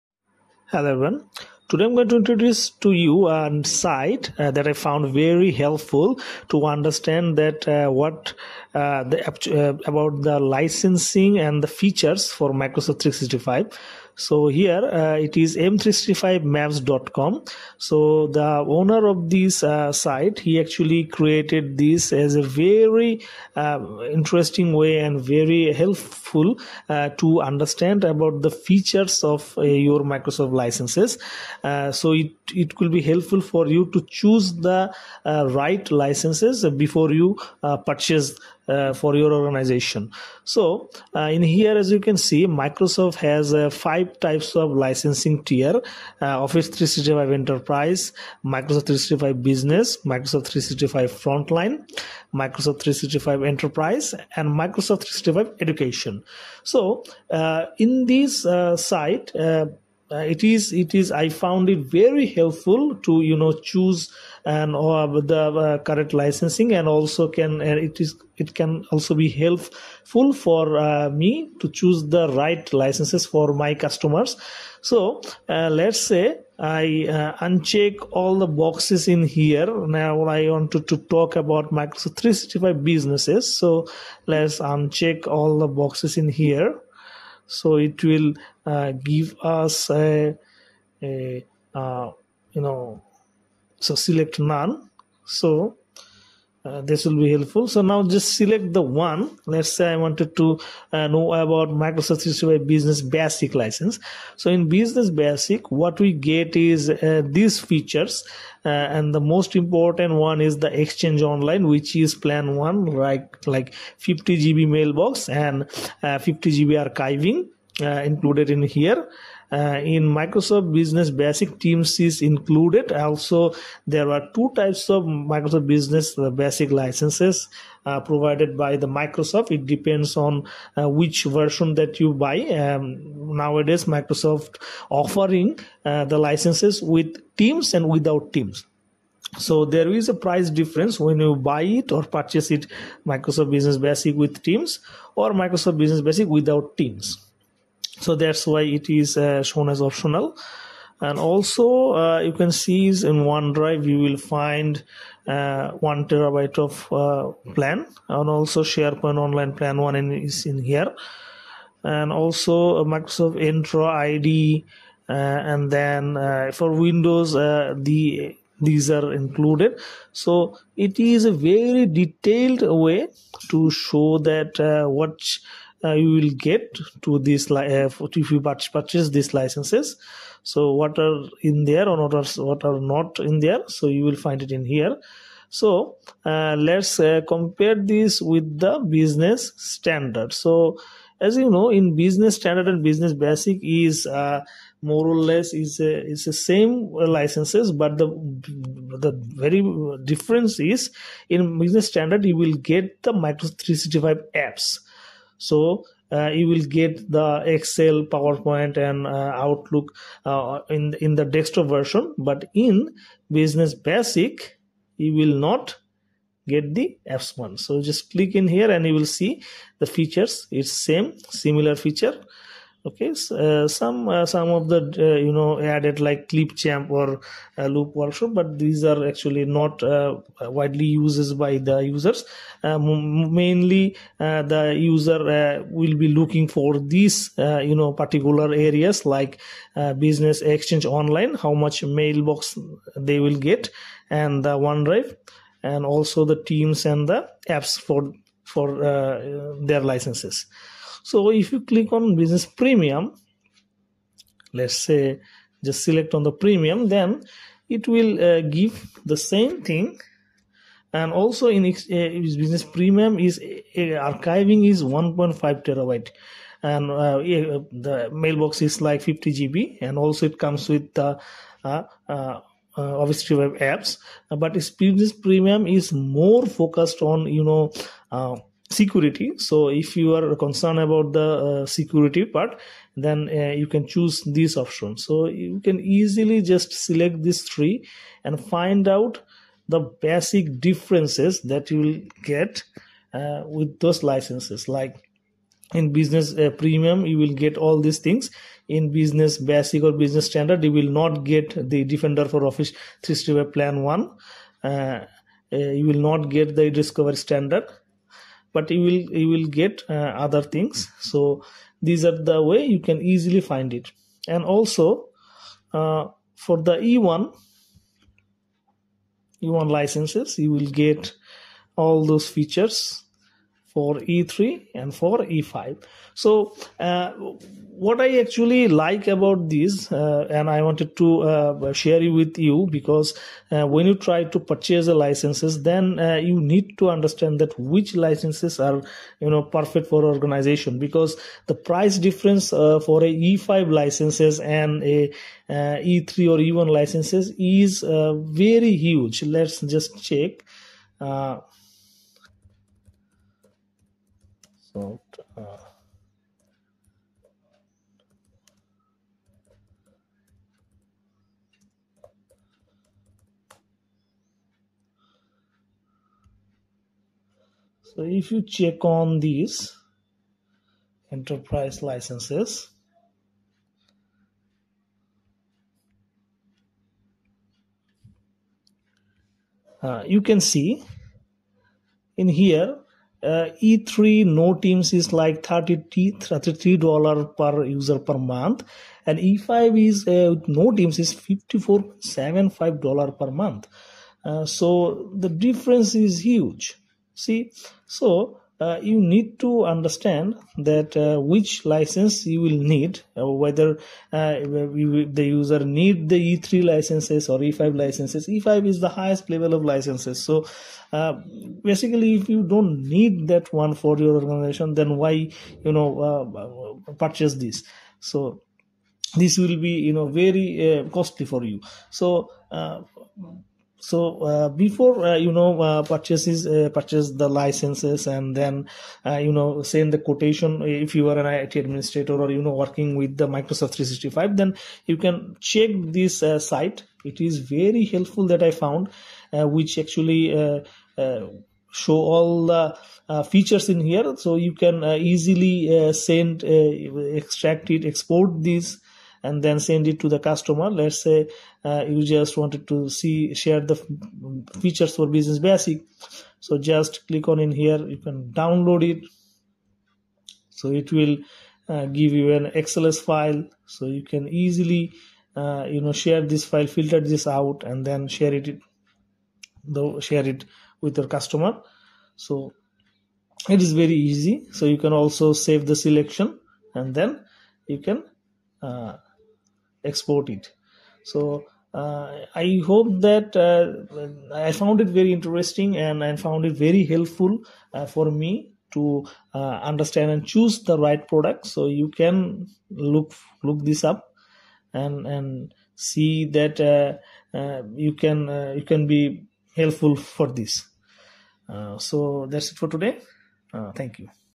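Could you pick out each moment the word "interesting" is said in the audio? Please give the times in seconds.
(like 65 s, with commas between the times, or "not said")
24 s, 485 s.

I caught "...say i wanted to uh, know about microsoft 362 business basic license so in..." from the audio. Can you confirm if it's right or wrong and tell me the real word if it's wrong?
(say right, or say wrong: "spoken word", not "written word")
wrong: "365", not "362".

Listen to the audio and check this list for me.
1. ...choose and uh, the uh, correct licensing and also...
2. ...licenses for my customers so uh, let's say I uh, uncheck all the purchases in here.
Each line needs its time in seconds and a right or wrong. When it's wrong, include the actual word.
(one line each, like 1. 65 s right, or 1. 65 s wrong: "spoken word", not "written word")
1. 63 s right
2. 72 s wrong: "boxes", not "purchases".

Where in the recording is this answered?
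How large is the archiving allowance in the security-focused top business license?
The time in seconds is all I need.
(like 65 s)
264 s.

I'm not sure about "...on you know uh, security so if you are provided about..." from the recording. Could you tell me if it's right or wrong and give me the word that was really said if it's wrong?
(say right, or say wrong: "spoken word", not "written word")
wrong: "concerned", not "provided".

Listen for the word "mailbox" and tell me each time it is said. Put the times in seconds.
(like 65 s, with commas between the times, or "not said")
114 s, 241 s, 268 s.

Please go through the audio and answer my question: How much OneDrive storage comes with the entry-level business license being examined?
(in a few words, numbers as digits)
1 terabyte.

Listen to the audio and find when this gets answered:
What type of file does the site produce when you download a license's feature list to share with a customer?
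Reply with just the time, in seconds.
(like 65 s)
462 s.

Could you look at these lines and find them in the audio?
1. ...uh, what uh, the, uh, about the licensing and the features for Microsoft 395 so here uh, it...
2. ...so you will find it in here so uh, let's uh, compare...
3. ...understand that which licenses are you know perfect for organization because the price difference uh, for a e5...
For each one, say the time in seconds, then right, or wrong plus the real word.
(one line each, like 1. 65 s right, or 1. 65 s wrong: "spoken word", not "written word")
1. 7 s wrong: "365", not "395"
2. 183 s right
3. 336 s right.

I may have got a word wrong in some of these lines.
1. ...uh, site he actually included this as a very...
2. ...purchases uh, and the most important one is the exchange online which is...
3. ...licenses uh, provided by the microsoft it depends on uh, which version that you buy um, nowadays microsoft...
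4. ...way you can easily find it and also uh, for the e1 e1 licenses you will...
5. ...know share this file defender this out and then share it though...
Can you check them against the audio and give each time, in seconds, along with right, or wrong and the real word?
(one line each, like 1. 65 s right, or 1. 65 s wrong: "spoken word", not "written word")
1. 19 s wrong: "created", not "included"
2. 107 s wrong: "features", not "purchases"
3. 126 s right
4. 312 s right
5. 465 s wrong: "filter", not "defender".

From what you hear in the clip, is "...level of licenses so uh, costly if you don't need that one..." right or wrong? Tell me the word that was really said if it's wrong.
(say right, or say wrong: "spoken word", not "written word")
wrong: "basically", not "costly".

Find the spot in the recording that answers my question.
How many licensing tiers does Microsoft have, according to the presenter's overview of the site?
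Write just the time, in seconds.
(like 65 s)
43 s.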